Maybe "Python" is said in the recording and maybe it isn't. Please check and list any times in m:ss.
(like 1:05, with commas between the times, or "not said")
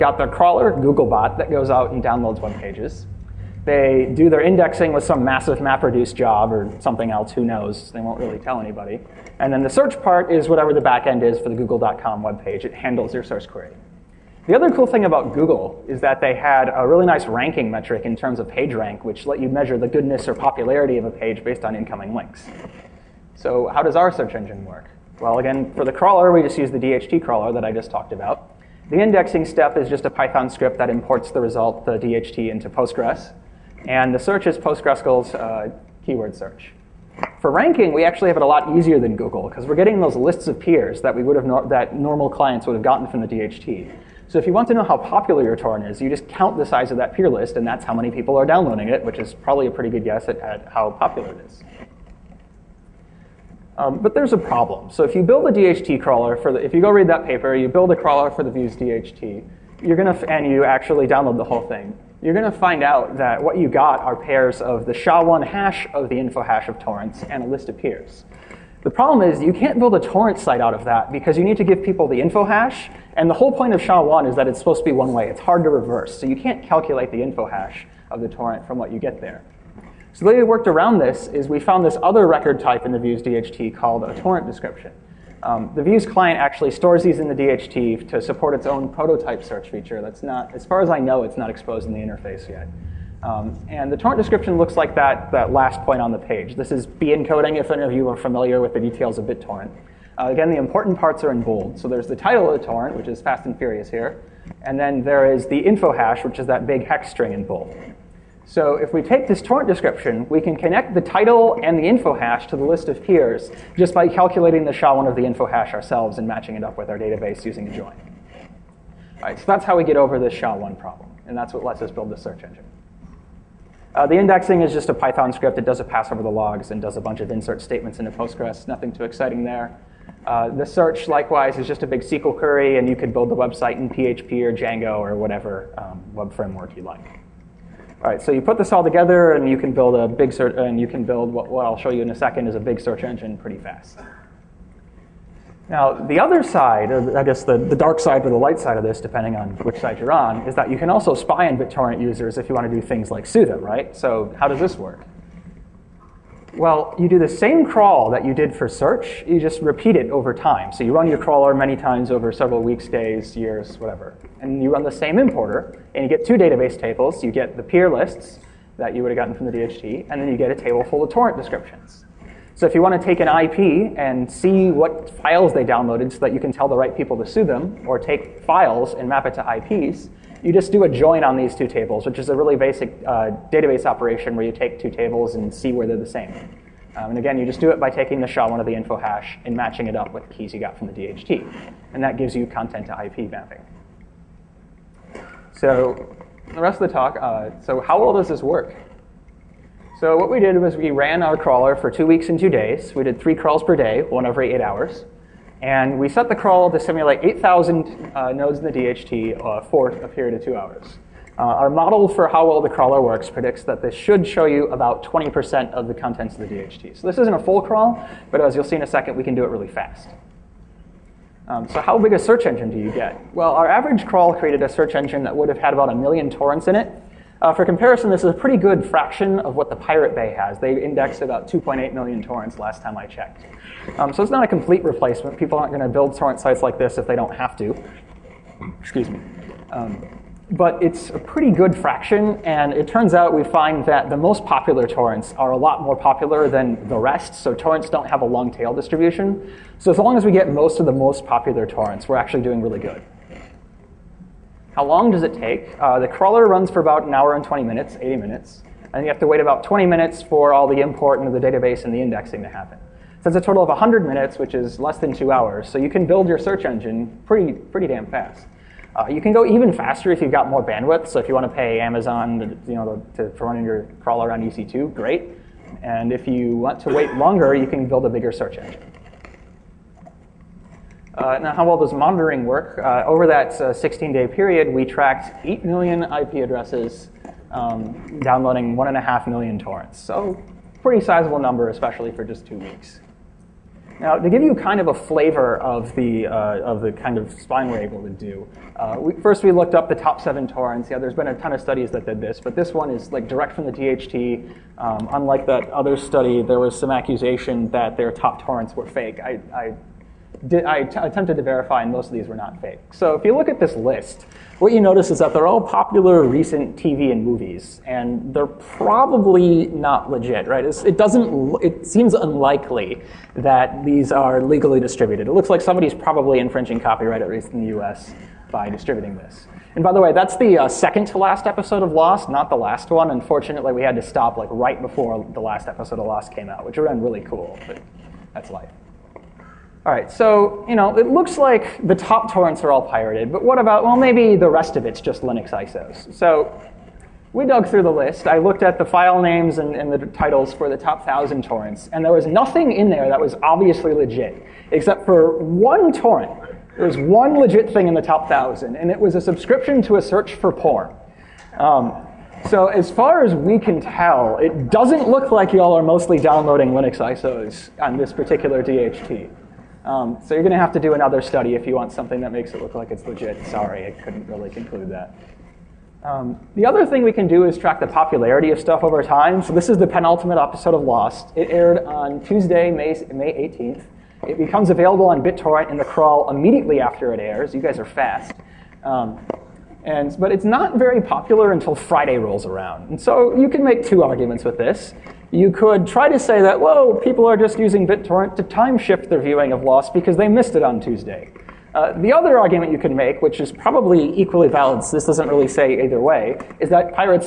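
0:30, 2:04.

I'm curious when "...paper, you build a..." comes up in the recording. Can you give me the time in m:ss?
0:57.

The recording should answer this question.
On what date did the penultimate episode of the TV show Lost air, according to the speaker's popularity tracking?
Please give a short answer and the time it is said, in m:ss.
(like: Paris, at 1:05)
May 18th, at 6:23.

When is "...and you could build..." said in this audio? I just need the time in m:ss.
2:12.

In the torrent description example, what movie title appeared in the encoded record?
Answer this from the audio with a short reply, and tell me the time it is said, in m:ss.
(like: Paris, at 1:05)
Fast and Furious, at 1:43.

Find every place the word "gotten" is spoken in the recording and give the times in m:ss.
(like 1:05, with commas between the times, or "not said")
0:42, 2:49.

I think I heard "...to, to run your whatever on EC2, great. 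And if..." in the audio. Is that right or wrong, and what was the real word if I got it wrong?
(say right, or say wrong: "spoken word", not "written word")
wrong: "crawler", not "whatever".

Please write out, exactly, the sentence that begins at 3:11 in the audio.
And that gives you content to IP mapping.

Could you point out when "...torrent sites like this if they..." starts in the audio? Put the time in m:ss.
3:56.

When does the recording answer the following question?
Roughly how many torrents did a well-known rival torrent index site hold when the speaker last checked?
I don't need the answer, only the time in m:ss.
3:51.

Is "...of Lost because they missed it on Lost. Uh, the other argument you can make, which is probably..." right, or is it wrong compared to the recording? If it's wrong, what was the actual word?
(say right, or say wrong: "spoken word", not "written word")
wrong: "Tuesday", not "Lost".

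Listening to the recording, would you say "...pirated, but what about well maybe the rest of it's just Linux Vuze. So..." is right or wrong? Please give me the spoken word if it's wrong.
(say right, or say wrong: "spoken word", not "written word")
wrong: "ISOs", not "Vuze".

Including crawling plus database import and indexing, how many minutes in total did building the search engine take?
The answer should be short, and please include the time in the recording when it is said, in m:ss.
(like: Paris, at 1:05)
100 minutes, at 4:23.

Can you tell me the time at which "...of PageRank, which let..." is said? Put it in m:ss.
0:18.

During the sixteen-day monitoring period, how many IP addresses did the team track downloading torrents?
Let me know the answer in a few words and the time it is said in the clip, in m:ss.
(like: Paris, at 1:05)
8 million, at 4:45.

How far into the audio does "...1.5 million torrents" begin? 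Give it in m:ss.
4:48.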